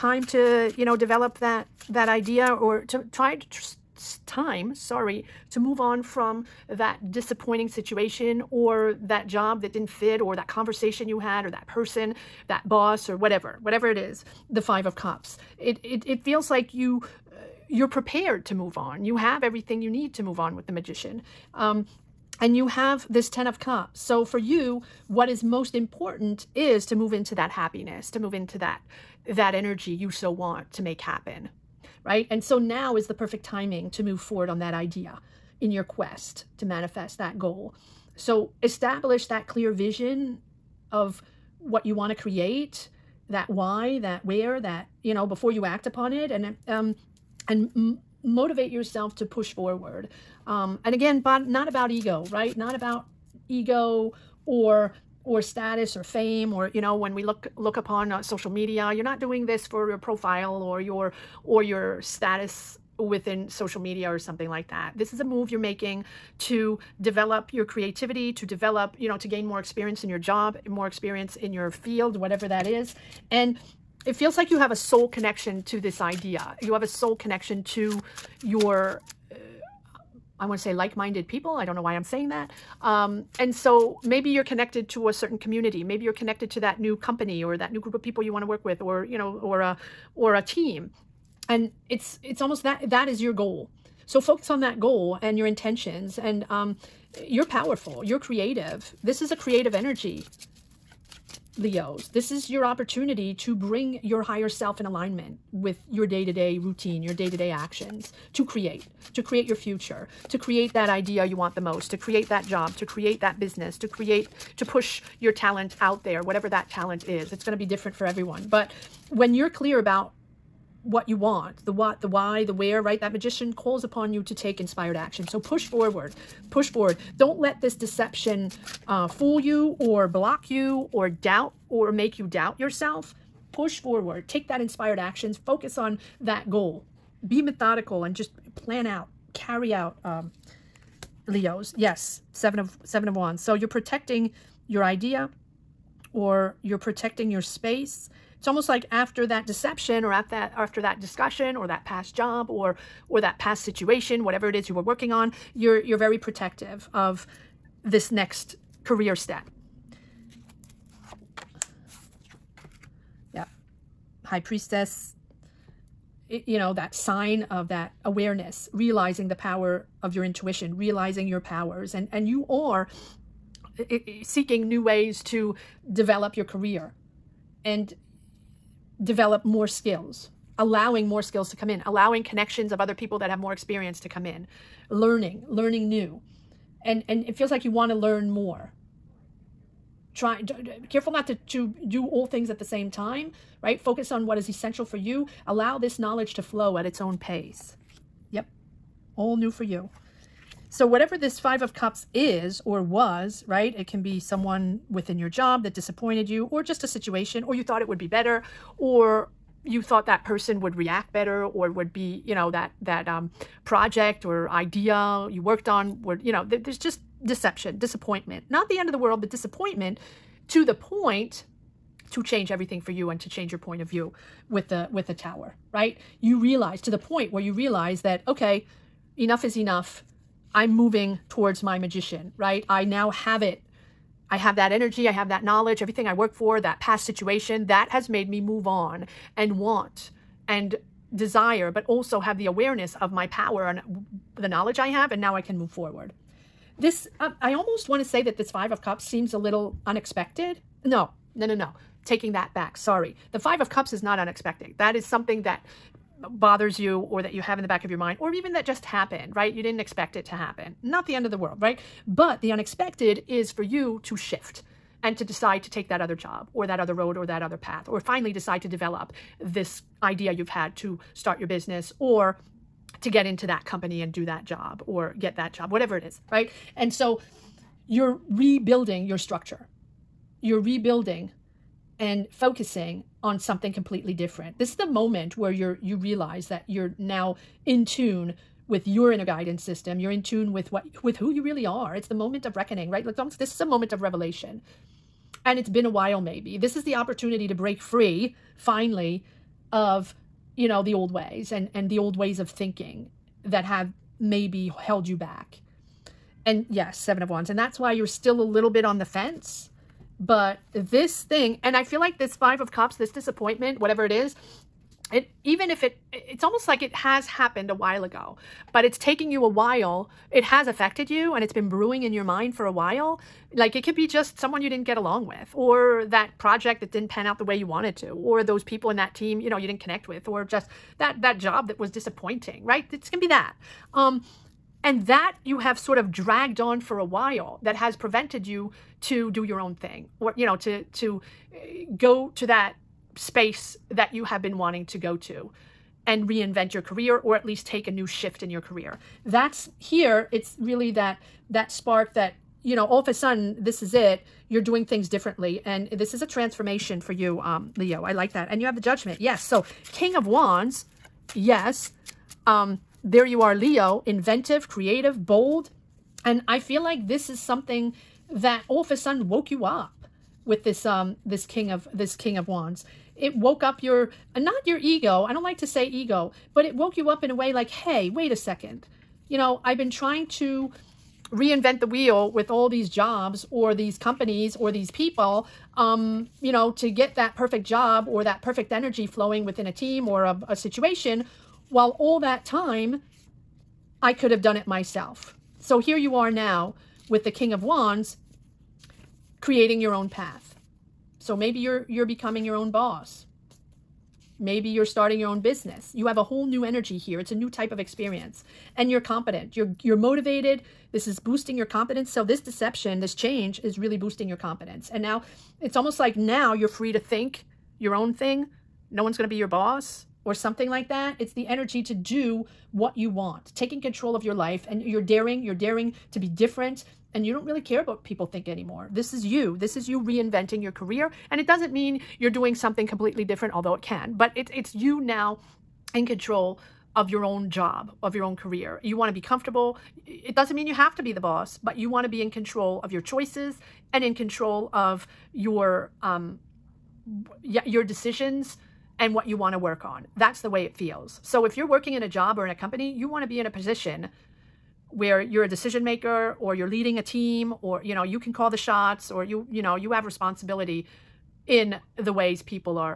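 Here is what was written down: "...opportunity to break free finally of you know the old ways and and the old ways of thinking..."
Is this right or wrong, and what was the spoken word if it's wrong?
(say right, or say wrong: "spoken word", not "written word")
right.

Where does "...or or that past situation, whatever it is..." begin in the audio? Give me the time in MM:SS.
02:32.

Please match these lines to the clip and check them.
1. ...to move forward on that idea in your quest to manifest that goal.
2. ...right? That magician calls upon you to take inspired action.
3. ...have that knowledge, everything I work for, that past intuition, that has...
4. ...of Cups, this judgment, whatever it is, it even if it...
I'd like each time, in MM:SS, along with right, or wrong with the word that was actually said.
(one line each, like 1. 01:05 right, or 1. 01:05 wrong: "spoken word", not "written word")
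1. 00:33 right
2. 02:02 right
3. 03:55 wrong: "situation", not "intuition"
4. 05:12 wrong: "disappointment", not "judgment".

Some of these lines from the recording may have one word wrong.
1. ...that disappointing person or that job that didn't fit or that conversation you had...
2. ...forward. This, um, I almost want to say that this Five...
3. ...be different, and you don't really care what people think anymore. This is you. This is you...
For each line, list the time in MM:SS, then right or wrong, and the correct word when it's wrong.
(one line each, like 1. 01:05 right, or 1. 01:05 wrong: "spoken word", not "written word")
1. 00:06 wrong: "situation", not "person"
2. 04:05 right
3. 07:06 right.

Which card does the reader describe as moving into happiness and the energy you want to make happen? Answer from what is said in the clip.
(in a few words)
10 of Cups.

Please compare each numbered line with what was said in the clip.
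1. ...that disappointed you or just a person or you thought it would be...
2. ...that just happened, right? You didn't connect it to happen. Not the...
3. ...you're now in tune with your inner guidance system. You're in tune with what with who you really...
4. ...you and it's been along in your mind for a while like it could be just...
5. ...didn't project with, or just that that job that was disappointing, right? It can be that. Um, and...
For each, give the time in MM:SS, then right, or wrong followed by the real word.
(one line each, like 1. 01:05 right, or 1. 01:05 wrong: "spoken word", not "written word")
1. 03:25 wrong: "situation", not "person"
2. 04:18 wrong: "expect", not "connect"
3. 04:46 right
4. 05:21 wrong: "brewing", not "along"
5. 05:29 wrong: "connect", not "project".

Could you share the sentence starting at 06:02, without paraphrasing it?
Um, there you are, Leo, inventive, creative, bold.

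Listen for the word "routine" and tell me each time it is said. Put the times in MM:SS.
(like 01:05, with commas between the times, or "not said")
01:46.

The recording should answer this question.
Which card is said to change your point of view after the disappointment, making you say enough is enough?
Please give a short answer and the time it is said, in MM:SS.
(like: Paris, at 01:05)
The Tower, at 03:45.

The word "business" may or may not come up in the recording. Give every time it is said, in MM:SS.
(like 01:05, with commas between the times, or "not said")
01:53, 04:31, 06:45.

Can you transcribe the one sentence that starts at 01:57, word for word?
It's going to be different for everyone.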